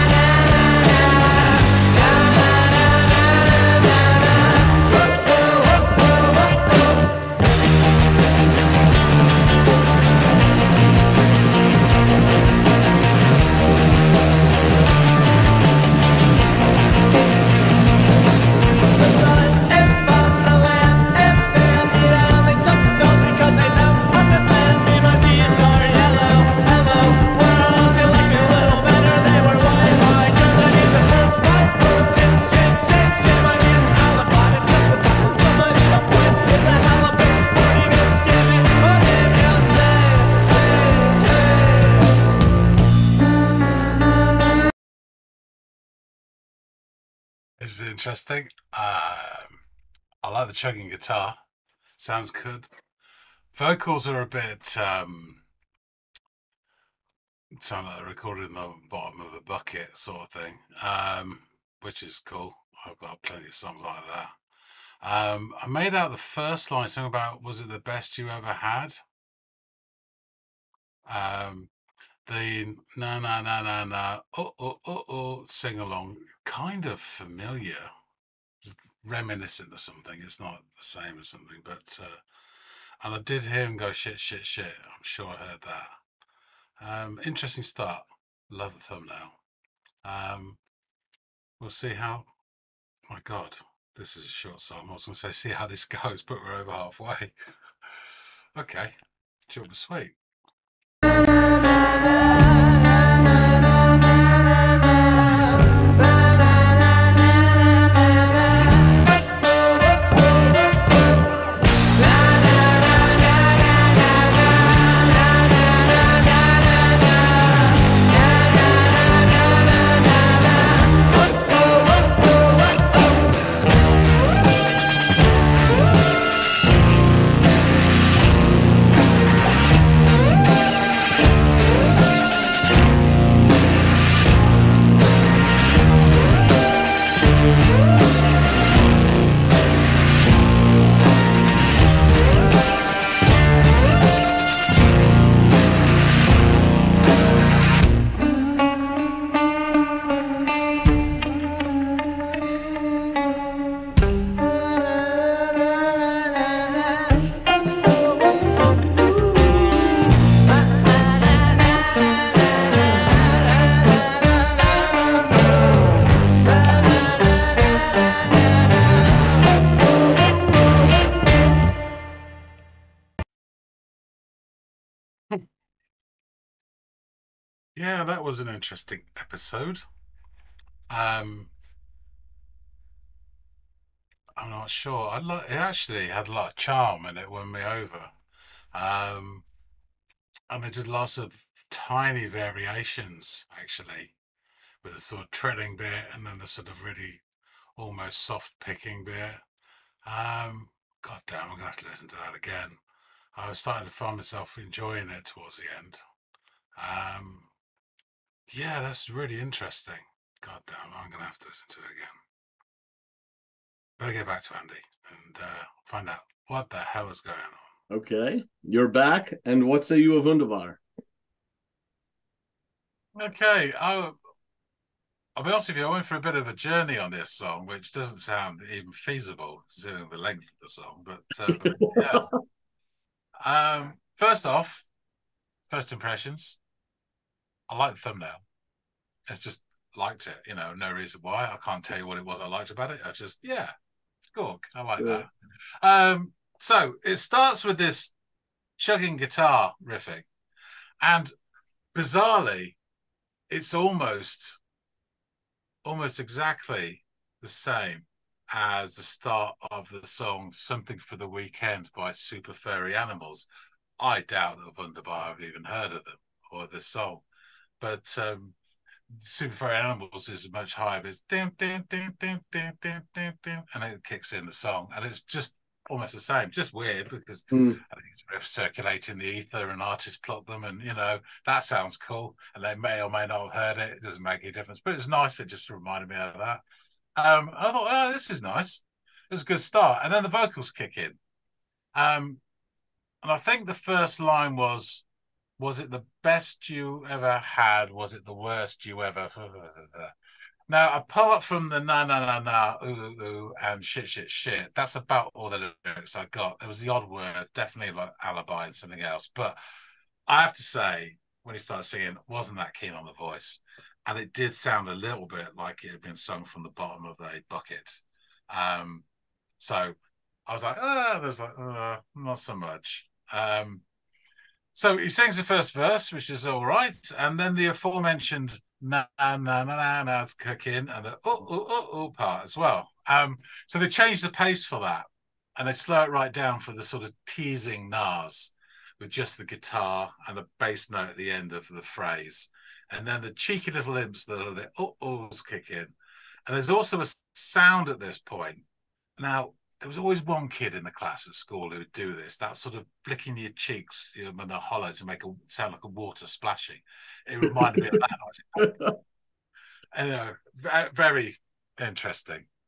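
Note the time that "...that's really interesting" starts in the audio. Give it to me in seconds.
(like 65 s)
208 s.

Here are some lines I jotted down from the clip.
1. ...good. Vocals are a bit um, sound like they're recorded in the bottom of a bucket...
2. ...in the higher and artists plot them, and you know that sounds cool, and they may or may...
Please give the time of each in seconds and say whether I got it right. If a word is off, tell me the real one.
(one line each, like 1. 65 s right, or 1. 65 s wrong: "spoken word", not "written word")
1. 52 s right
2. 279 s wrong: "ether", not "higher".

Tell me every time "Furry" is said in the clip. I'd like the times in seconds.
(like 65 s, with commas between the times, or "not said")
262 s, 269 s.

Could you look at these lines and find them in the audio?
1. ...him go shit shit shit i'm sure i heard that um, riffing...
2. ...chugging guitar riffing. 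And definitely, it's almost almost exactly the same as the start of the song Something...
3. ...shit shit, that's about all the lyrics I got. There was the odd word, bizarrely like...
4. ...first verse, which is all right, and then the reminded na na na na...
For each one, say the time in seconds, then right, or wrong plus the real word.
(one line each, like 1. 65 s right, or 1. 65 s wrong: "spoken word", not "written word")
1. 83 s wrong: "interesting", not "riffing"
2. 248 s wrong: "bizarrely", not "definitely"
3. 304 s wrong: "definitely", not "bizarrely"
4. 325 s wrong: "aforementioned", not "reminded".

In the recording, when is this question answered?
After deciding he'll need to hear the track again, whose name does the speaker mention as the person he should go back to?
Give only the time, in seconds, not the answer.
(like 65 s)
214 s.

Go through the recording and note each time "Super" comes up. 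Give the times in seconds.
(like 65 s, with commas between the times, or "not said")
262 s, 269 s.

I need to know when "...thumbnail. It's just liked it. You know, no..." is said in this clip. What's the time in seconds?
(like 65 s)
237 s.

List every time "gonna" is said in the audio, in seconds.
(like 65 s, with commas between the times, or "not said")
95 s, 201 s.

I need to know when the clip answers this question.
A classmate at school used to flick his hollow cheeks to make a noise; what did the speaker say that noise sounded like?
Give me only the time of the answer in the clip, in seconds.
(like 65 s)
355 s.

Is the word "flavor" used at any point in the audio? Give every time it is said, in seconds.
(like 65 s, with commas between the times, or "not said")
not said.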